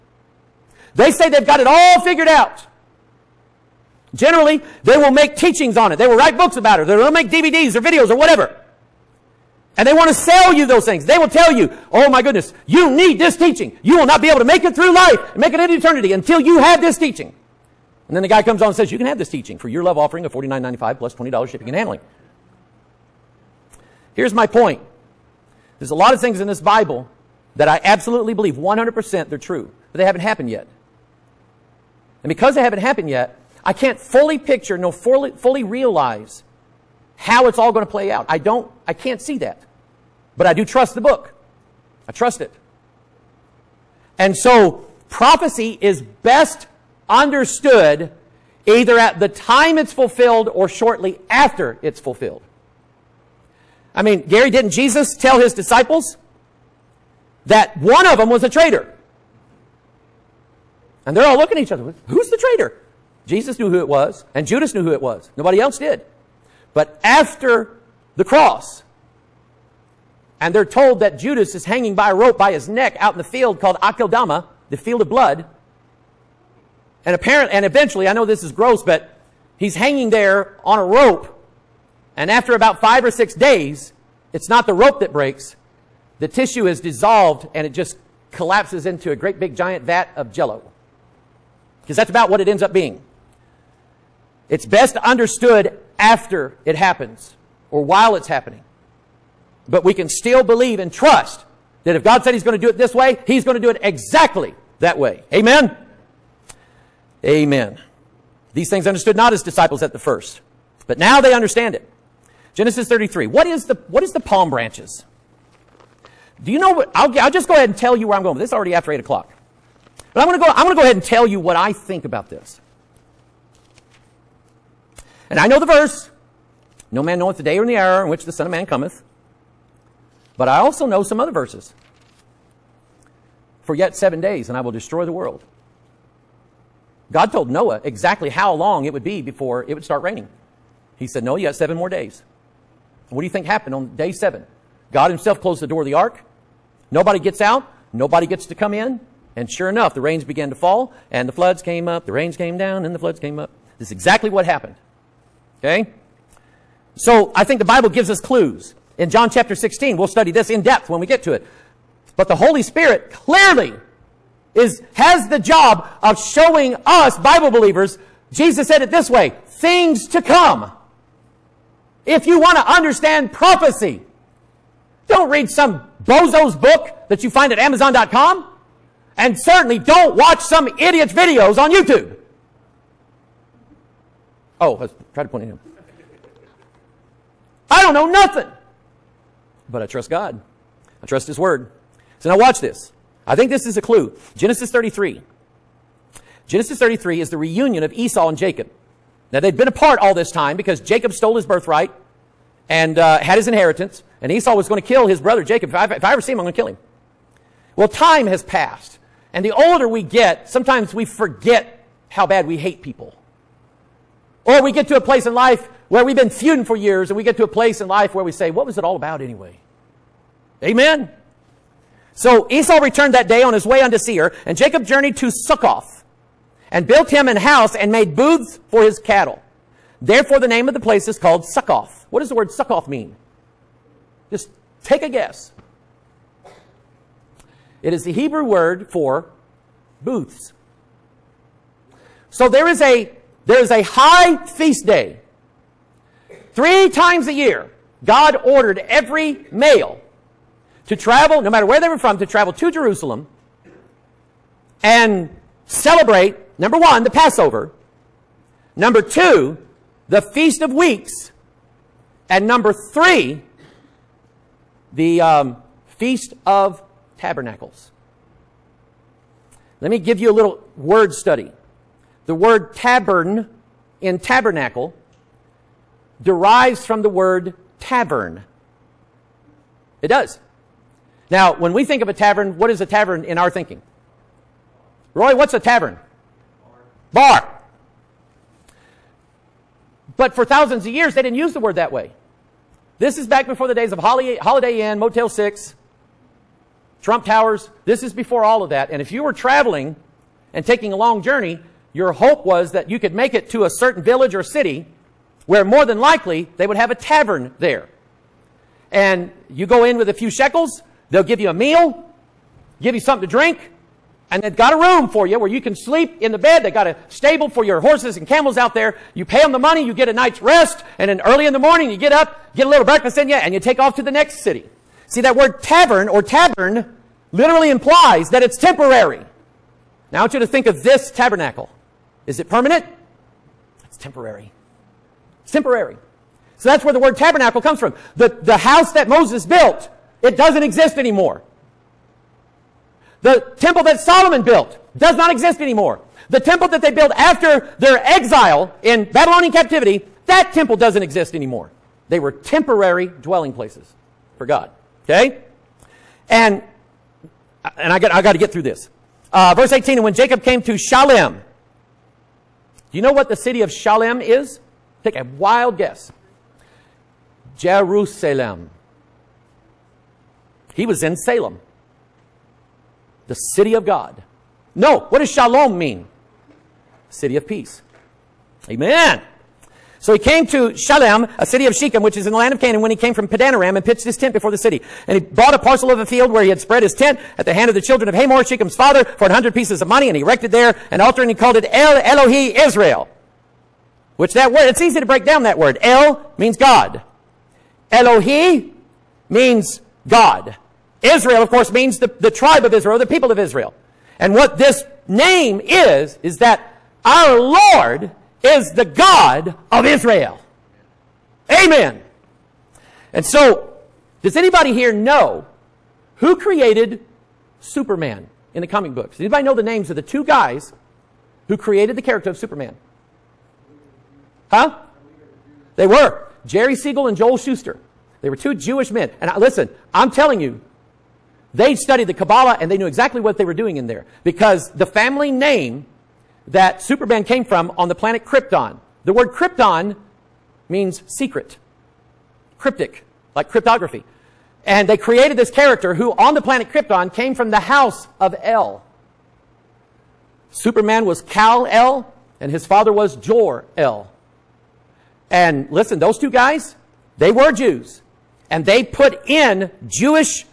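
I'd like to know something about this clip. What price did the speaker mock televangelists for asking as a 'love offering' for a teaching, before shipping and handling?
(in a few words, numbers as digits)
$49.95.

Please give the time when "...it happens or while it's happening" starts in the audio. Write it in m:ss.
1:36.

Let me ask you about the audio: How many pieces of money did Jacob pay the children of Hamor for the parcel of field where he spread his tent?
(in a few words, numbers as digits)
100.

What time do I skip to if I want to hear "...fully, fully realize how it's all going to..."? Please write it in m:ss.
0:34.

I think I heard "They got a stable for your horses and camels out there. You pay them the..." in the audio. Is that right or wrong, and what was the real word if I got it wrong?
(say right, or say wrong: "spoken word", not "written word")
right.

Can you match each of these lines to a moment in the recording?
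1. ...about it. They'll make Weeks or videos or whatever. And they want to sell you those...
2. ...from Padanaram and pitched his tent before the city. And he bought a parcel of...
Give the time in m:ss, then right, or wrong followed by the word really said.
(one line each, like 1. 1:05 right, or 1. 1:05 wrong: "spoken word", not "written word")
1. 0:06 wrong: "DVDs", not "Weeks"
2. 6:23 right.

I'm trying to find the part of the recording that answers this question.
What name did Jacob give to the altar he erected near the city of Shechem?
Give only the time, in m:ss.
6:31.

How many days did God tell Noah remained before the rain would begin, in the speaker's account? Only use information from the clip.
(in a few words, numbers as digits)
7.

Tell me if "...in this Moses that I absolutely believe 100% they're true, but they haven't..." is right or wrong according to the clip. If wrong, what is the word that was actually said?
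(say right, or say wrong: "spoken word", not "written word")
wrong: "Bible", not "Moses".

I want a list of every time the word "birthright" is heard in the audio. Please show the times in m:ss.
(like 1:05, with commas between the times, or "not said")
3:21.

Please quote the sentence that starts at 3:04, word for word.
Oh, I was trying to point at him.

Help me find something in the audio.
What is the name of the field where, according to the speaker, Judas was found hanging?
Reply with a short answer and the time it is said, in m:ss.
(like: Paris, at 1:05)
Akeldama, at 1:13.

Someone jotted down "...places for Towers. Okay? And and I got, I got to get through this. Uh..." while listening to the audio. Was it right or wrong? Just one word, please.
wrong.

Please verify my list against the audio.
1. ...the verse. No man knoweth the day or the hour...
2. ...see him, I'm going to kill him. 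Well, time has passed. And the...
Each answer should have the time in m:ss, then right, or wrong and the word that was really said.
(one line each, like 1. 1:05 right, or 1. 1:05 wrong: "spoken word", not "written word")
1. 2:05 right
2. 3:26 right.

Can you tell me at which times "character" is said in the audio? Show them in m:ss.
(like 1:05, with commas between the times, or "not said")
7:02, 7:25.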